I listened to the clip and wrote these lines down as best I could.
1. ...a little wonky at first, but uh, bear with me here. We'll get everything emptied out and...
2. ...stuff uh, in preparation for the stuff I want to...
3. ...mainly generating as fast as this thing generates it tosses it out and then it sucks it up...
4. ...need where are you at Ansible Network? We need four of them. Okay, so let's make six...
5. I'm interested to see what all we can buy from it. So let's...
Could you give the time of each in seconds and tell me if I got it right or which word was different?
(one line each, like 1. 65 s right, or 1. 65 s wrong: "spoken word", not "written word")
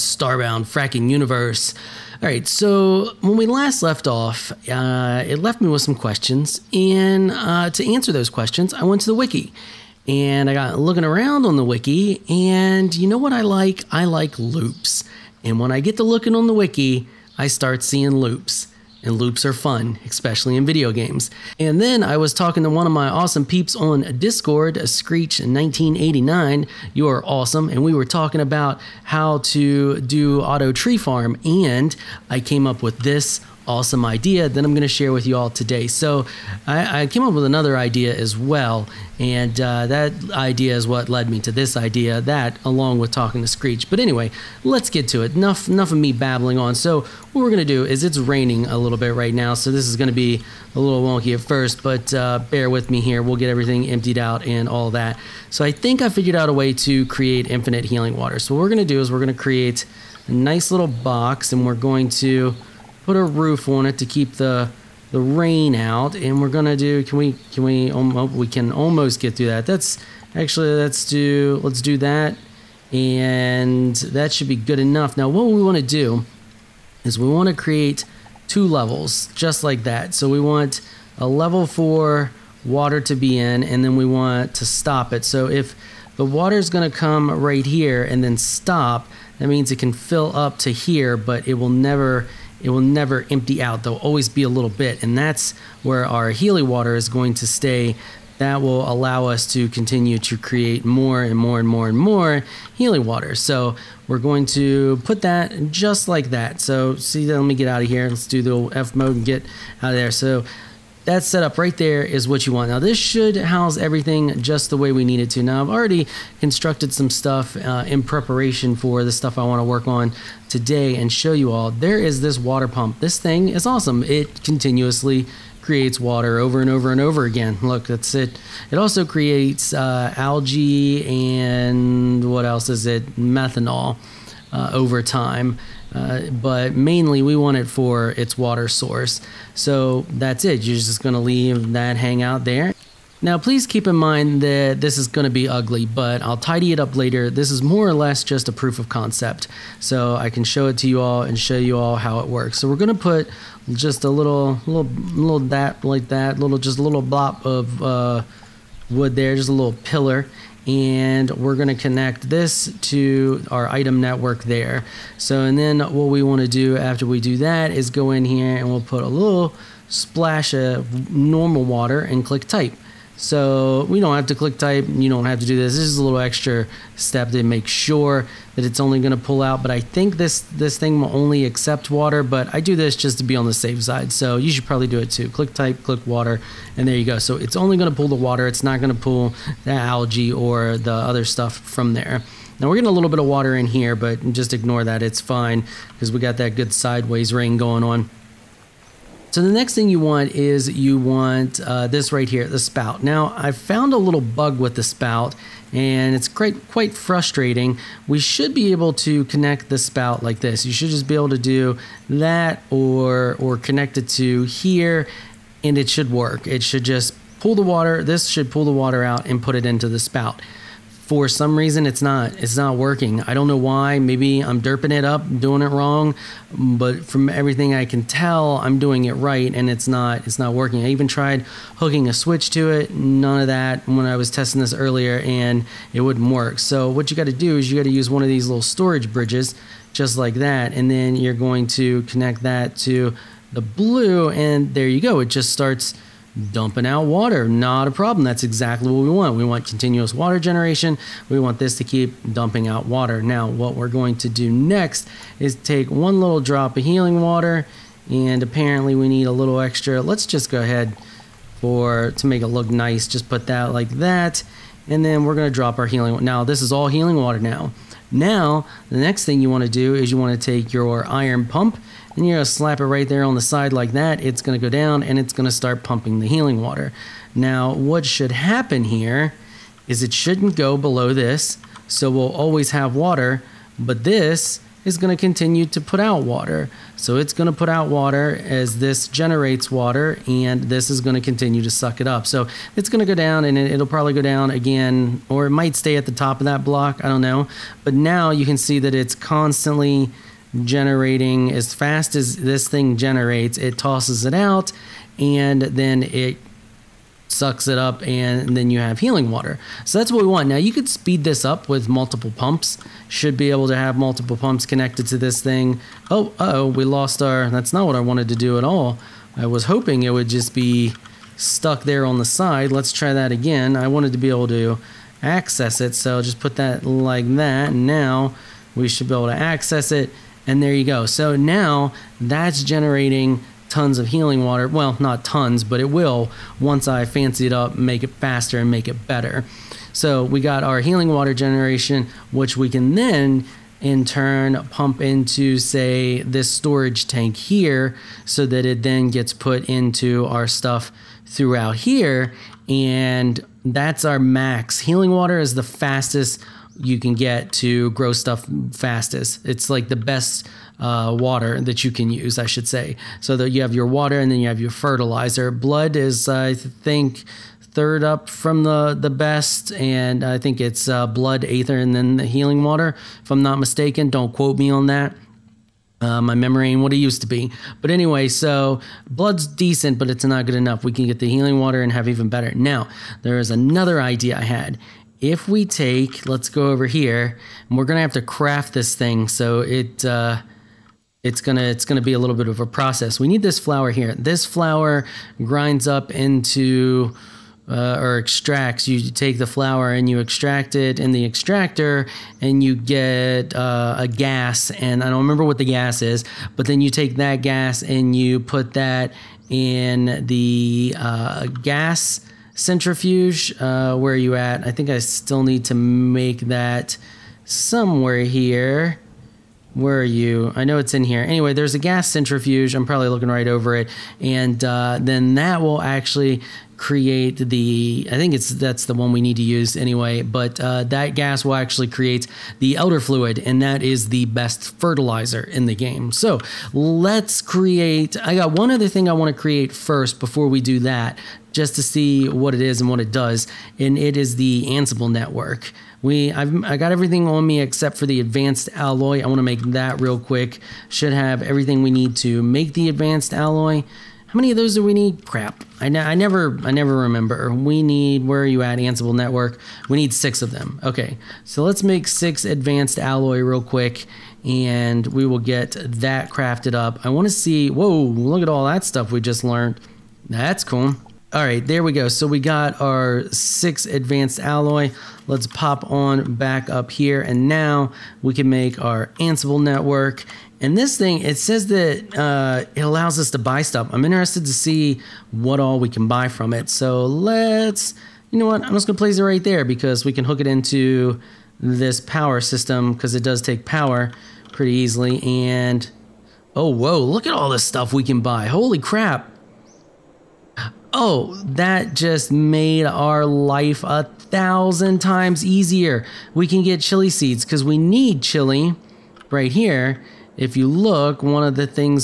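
1. 50 s right
2. 117 s right
3. 299 s wrong: "constantly", not "mainly"
4. 457 s wrong: "six", not "four"
5. 483 s right.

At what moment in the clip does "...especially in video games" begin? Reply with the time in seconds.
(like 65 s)
20 s.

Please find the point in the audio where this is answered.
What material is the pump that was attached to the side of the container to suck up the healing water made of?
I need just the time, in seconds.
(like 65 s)
271 s.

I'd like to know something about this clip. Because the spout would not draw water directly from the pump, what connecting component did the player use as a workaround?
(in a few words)
storage bridges.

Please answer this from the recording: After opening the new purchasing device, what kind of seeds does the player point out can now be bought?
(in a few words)
chili seeds.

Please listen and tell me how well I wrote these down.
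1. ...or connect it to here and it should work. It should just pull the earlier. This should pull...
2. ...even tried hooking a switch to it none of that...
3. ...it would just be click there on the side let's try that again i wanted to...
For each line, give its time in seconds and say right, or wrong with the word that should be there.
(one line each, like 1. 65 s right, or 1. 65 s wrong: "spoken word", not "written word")
1. 213 s wrong: "water", not "earlier"
2. 230 s right
3. 320 s wrong: "stuck", not "click".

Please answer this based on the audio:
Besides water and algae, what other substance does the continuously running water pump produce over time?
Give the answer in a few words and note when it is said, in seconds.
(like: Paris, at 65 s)
Methanol, at 133 s.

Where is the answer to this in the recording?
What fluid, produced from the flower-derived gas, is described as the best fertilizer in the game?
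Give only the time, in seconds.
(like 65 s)
432 s.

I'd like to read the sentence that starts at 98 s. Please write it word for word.
That will allow us to continue to create more and more and more and more Healy water.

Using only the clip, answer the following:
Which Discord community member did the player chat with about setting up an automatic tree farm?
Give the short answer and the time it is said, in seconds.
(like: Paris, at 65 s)
Screech 1989, at 24 s.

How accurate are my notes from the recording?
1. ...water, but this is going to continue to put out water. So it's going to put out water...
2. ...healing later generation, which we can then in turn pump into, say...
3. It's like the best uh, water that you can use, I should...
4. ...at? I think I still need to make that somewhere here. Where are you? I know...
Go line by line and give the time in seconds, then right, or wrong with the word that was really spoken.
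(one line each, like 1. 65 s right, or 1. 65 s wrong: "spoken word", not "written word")
1. 282 s right
2. 340 s wrong: "water", not "later"
3. 359 s right
4. 414 s right.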